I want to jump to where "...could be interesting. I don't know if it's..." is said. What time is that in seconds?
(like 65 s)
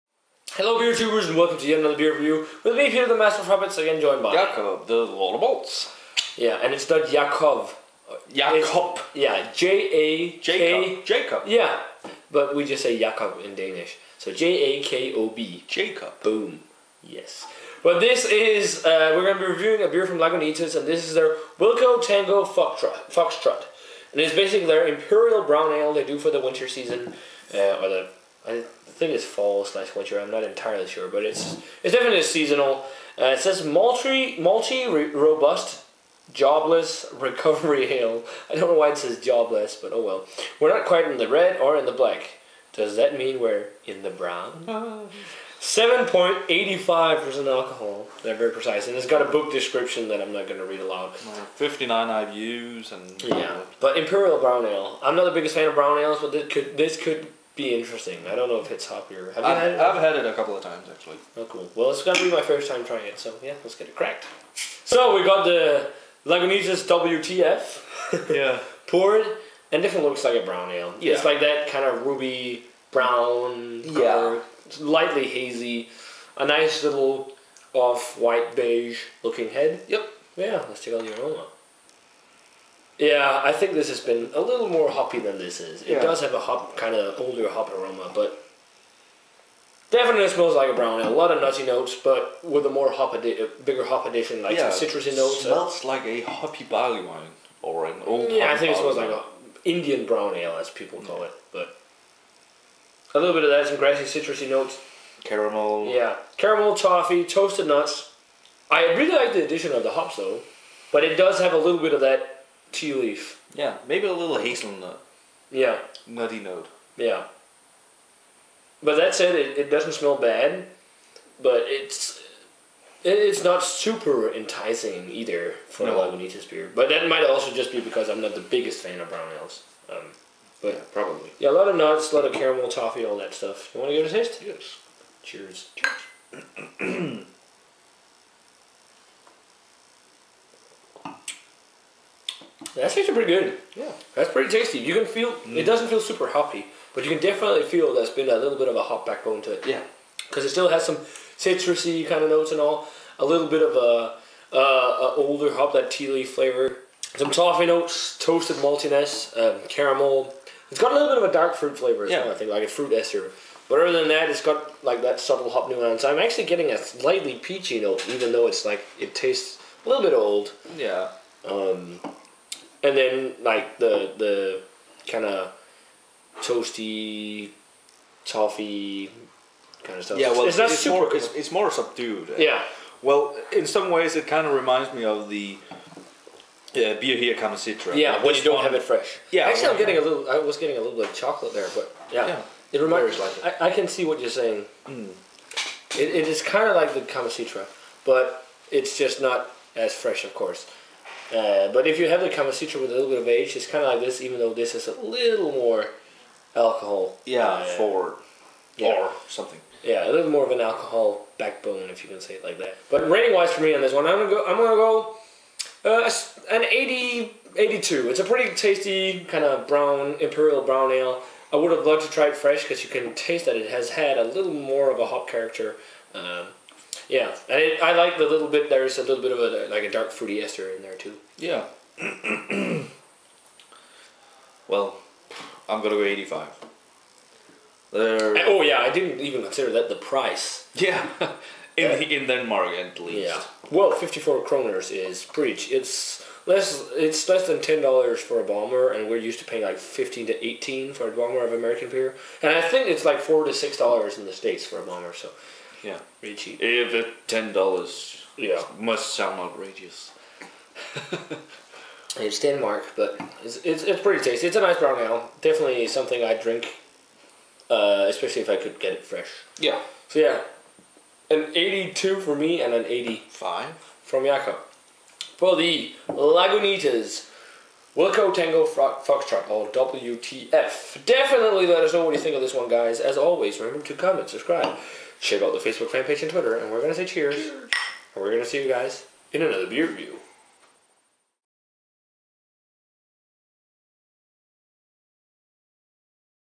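56 s.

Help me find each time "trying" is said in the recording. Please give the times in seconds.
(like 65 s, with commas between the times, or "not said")
62 s.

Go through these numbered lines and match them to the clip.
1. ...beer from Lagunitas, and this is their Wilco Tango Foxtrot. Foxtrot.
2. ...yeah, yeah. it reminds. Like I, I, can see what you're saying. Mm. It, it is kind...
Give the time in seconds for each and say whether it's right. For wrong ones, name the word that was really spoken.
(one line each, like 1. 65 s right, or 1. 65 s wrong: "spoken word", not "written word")
1. 19 s right
2. 192 s right.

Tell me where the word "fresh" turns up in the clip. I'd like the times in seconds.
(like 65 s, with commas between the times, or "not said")
188 s, 199 s, 222 s, 269 s.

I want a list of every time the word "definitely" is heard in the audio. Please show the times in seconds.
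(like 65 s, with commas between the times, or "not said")
31 s, 69 s, 89 s, 147 s, 265 s, 281 s.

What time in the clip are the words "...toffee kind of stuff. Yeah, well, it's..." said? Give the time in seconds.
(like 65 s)
178 s.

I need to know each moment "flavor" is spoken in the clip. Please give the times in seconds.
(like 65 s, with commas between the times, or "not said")
156 s, 161 s.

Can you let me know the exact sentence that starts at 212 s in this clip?
But rating wise for me on this one, I'm gonna go.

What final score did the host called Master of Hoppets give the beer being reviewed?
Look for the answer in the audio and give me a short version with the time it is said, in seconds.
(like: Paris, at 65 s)
82, at 271 s.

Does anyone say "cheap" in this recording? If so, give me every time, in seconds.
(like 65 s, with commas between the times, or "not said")
256 s.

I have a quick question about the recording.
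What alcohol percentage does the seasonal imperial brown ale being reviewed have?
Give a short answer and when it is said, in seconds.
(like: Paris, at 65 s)
7.85%, at 45 s.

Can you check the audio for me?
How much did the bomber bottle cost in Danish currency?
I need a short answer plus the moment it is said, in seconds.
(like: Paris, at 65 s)
54 kroner, at 243 s.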